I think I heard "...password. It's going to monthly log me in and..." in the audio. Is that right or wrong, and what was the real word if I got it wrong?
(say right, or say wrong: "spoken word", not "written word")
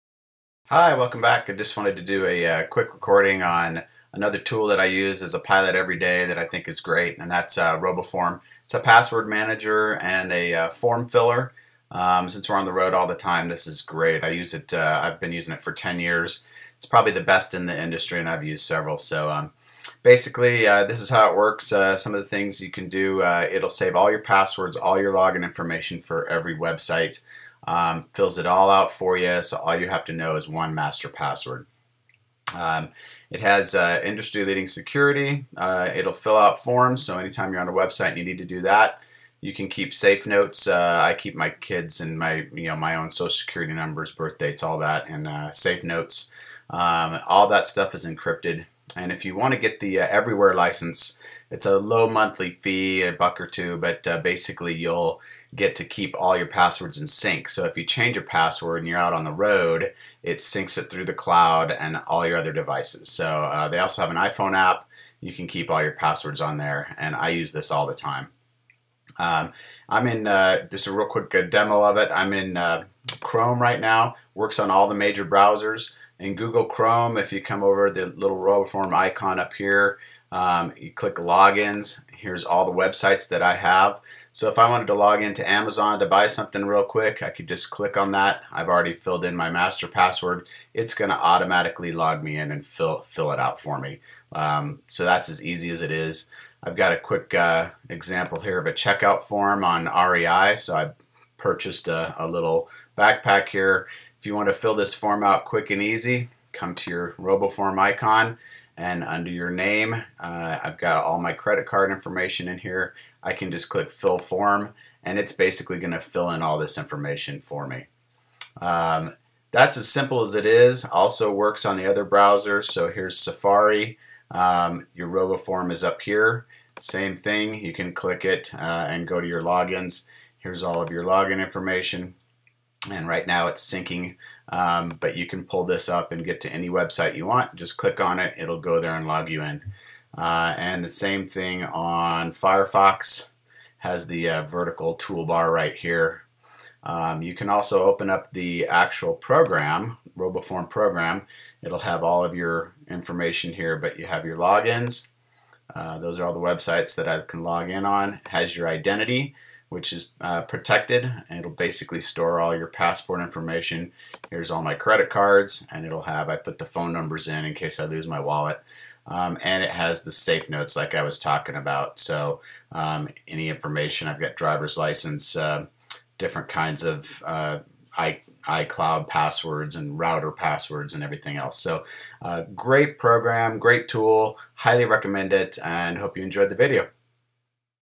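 wrong: "automatically", not "monthly".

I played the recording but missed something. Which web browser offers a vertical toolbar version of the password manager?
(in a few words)
Firefox.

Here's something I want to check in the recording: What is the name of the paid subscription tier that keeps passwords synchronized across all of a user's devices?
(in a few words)
Everywhere.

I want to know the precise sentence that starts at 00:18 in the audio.
So um, basically, uh, this is how it works.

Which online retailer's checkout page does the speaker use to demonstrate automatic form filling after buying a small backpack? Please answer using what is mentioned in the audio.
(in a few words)
REI.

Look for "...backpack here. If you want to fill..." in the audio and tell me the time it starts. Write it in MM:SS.
01:42.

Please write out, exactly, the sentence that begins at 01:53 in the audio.
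I can just click fill form and it's basically going to fill in all this information for me.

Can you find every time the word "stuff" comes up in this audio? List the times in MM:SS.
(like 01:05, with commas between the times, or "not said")
00:47.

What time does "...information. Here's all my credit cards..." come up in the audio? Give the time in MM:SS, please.
02:43.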